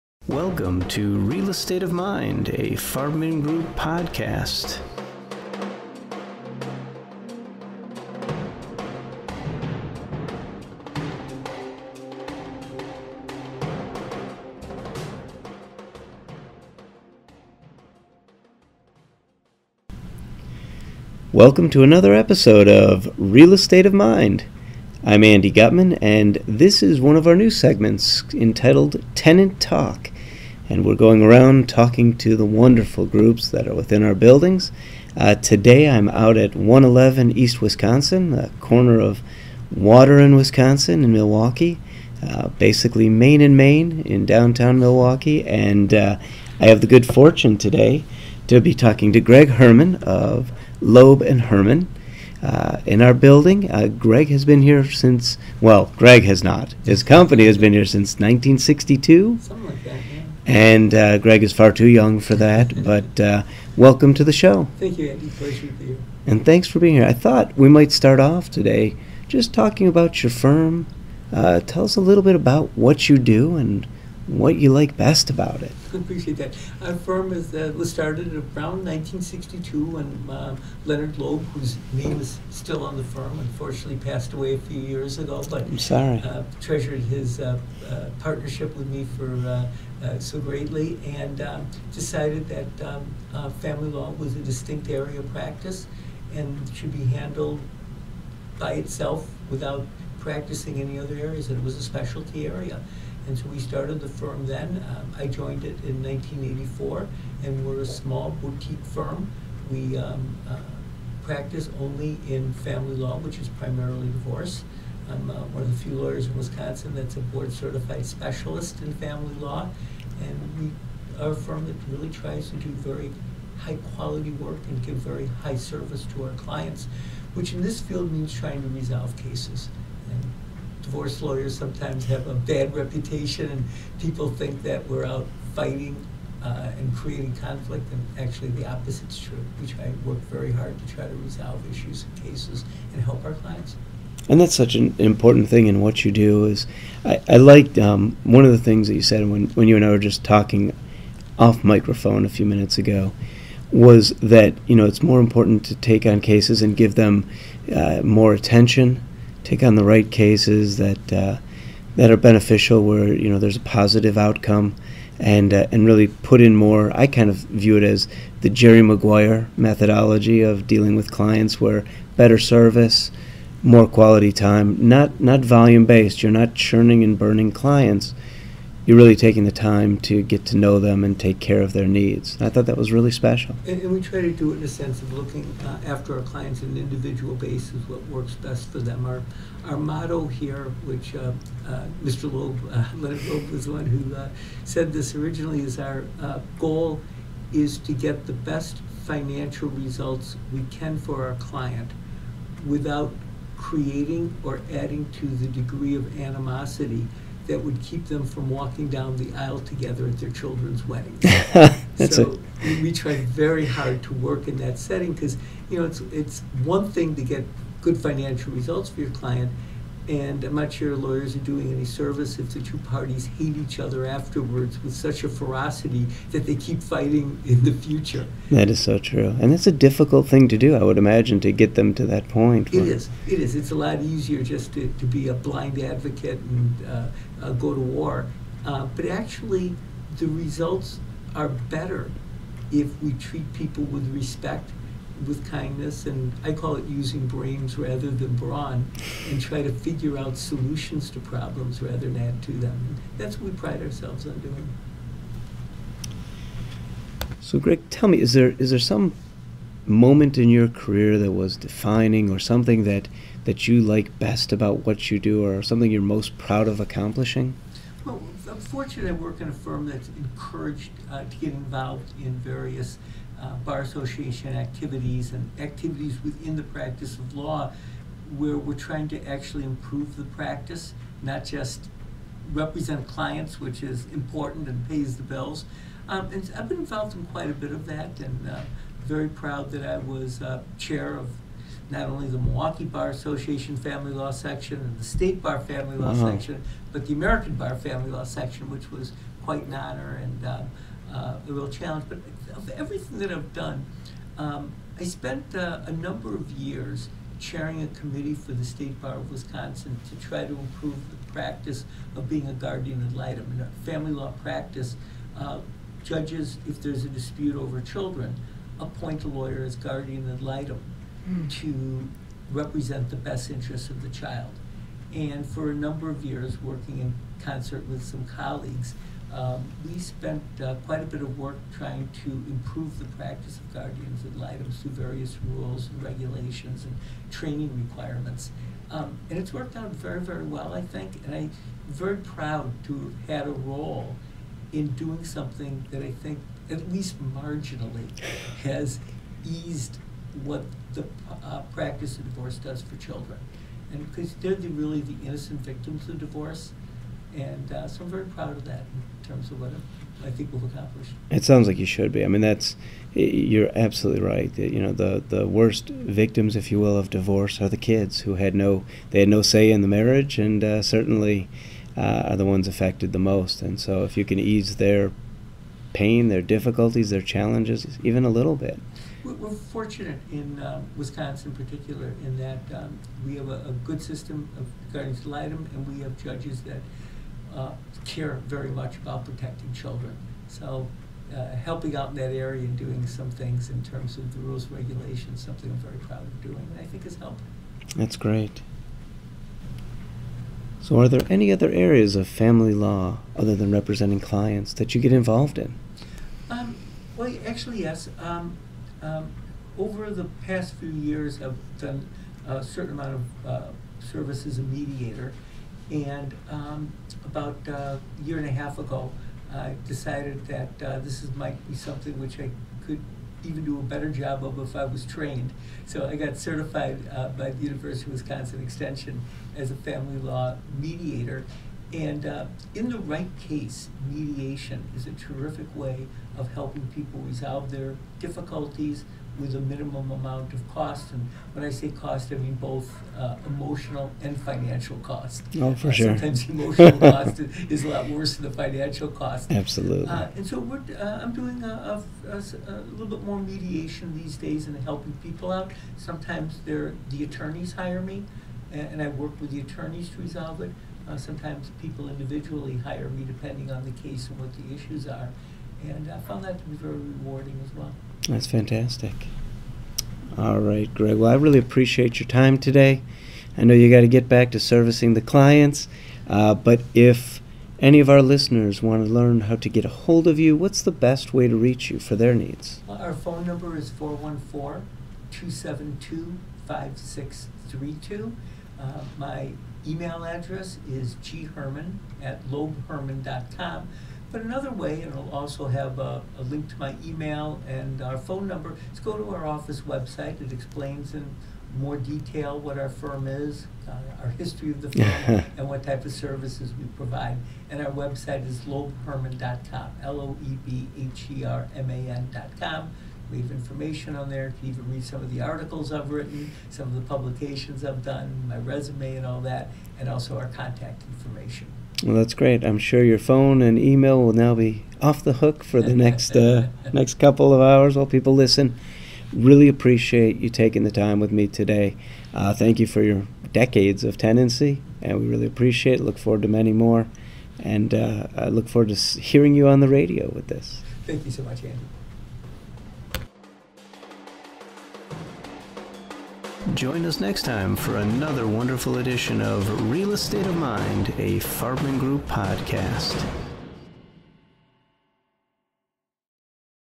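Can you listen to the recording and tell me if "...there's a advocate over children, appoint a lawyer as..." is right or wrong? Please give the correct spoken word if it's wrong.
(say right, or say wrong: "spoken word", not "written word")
wrong: "dispute", not "advocate".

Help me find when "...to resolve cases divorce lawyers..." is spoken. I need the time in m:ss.
2:08.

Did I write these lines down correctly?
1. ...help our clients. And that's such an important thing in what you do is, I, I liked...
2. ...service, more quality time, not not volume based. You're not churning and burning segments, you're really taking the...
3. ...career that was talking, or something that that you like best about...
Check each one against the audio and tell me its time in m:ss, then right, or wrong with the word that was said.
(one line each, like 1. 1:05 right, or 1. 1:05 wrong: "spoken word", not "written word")
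1. 2:23 right
2. 2:52 wrong: "clients", not "segments"
3. 4:20 wrong: "defining", not "talking".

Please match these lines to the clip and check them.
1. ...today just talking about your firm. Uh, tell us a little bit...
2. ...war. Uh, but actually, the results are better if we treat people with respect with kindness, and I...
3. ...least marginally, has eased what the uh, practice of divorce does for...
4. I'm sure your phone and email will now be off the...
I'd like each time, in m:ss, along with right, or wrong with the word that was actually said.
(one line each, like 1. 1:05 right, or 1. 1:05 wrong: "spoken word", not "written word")
1. 1:08 right
2. 3:57 right
3. 5:46 right
4. 8:42 right.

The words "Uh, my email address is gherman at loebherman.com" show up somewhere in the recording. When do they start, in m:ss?
8:08.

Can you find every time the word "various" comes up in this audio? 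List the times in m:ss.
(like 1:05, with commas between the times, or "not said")
4:32, 5:34.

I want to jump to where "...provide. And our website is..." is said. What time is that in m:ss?
8:26.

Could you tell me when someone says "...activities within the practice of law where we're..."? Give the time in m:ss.
4:35.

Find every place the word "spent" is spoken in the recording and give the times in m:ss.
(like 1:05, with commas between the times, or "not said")
5:05, 5:29.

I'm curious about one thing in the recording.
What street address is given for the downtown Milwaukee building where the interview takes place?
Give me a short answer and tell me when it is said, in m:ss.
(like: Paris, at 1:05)
111 East Wisconsin, at 0:36.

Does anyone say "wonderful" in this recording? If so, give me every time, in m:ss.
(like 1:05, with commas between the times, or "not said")
0:32, 9:08.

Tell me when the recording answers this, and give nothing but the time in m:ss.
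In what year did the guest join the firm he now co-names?
1:46.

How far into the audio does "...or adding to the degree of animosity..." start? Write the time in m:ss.
3:24.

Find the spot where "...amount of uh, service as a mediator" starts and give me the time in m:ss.
6:52.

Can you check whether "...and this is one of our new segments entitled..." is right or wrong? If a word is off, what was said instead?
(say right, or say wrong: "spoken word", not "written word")
right.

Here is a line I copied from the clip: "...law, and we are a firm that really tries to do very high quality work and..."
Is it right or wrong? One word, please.
right.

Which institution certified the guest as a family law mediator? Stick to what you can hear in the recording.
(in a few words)
University of Wisconsin Extension.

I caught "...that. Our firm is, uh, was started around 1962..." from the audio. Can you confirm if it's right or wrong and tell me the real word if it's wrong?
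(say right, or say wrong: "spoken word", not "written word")
right.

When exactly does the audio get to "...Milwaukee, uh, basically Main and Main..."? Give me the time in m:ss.
0:41.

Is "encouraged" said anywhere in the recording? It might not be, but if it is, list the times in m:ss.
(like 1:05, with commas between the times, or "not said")
4:30.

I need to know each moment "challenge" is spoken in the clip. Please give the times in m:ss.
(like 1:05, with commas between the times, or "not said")
5:01, 6:17.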